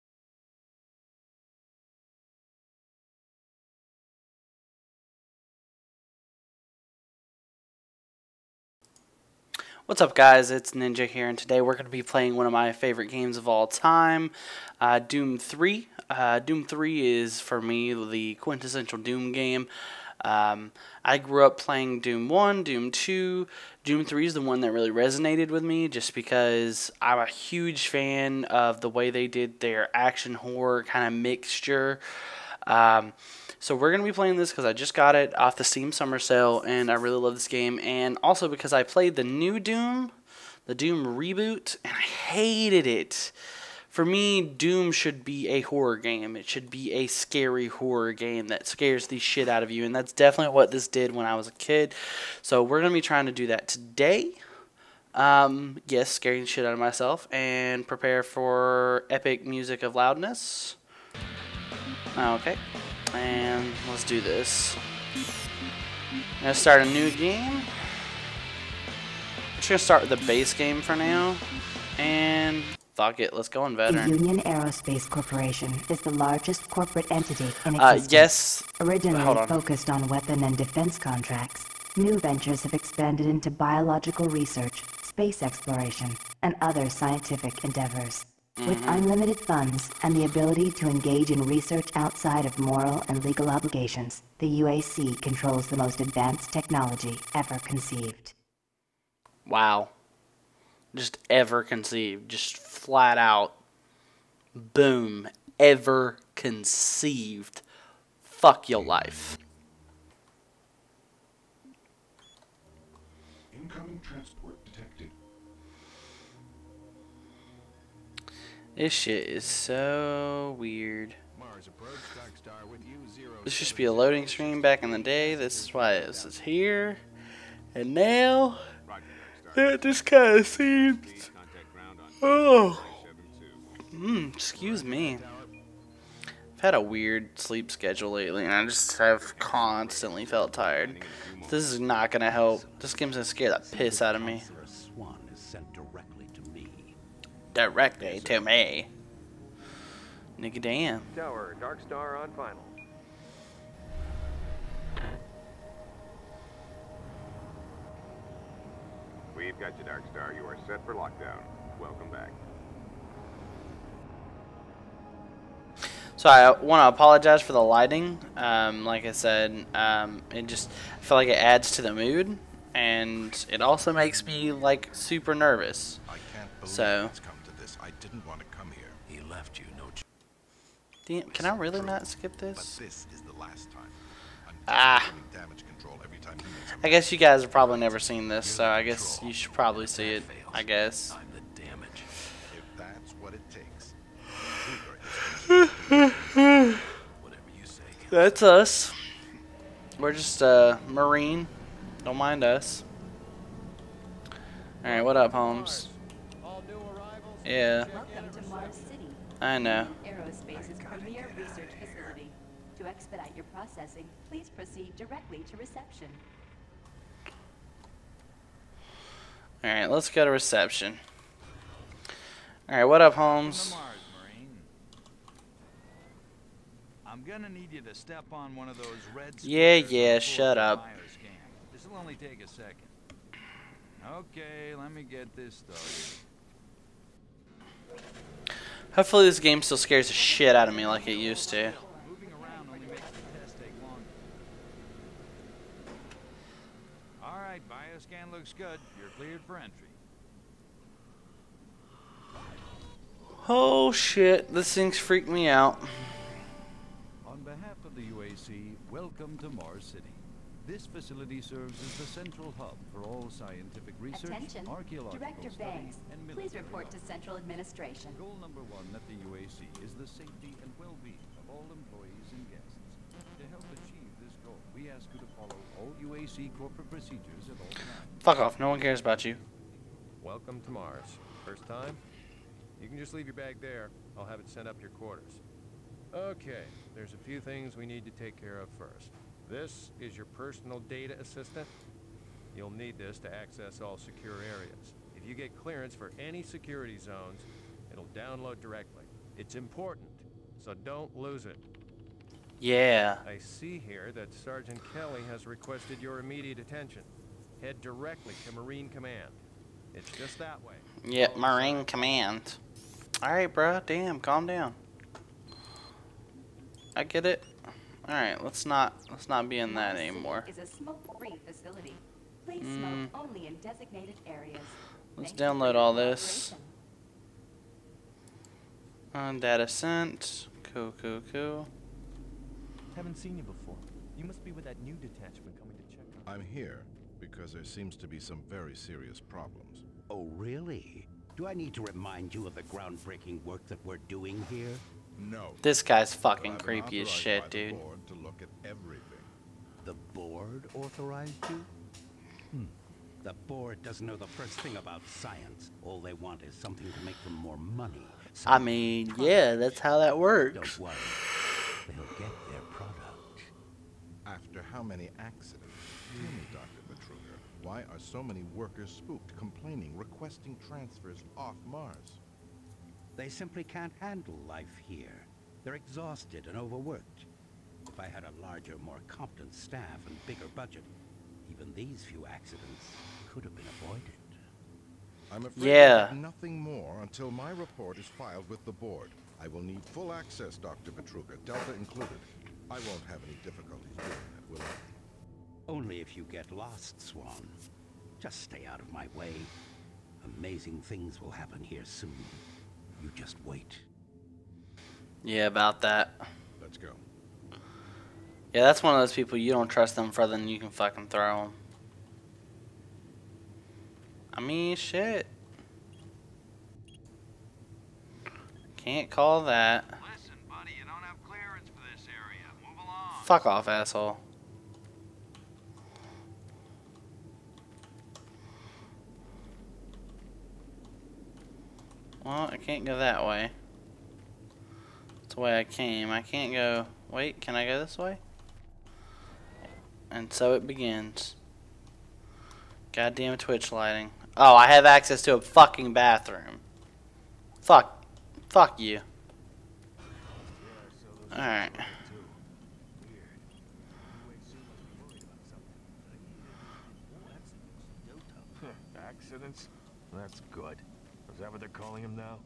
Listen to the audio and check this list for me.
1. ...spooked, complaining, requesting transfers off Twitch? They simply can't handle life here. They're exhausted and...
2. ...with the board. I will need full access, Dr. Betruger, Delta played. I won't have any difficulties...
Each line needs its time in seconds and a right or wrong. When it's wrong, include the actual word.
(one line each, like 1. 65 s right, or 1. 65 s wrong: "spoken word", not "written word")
1. 368 s wrong: "Mars", not "Twitch"
2. 388 s wrong: "included", not "played".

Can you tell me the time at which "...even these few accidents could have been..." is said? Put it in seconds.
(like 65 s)
381 s.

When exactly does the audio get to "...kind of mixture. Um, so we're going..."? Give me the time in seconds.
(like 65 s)
30 s.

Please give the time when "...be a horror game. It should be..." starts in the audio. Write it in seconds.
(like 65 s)
45 s.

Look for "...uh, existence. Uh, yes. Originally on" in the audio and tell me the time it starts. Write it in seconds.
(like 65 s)
77 s.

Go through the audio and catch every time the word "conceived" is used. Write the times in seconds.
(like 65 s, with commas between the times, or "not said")
97 s, 101 s, 106 s.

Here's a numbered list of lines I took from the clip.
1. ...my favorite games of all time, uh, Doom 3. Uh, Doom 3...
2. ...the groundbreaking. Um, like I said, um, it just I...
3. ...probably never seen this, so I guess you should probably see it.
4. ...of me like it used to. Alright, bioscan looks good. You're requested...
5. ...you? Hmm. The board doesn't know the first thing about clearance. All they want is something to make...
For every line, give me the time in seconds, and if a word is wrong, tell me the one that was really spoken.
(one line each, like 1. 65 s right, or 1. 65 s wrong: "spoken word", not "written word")
1. 12 s right
2. 167 s wrong: "lighting", not "groundbreaking"
3. 187 s right
4. 240 s wrong: "cleared", not "requested"
5. 351 s wrong: "science", not "clearance".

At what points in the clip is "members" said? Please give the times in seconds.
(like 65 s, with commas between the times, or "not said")
not said.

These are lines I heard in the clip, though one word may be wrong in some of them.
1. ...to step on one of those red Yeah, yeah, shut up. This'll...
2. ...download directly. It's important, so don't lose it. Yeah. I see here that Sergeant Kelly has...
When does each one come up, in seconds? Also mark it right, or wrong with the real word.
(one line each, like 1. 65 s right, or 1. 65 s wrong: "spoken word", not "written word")
1. 227 s right
2. 298 s right.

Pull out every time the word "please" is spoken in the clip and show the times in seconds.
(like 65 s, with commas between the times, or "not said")
214 s, 266 s, 322 s.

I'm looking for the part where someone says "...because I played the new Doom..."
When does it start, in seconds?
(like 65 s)
38 s.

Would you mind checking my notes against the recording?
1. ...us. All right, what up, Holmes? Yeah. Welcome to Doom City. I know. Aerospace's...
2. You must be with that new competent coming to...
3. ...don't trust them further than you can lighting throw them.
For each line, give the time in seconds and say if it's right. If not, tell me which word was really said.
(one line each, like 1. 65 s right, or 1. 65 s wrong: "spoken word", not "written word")
1. 202 s wrong: "Mars", not "Doom"
2. 334 s wrong: "detachment", not "competent"
3. 409 s wrong: "fucking", not "lighting".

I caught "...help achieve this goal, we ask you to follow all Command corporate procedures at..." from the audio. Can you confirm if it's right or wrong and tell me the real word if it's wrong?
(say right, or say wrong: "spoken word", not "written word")
wrong: "UAC", not "Command".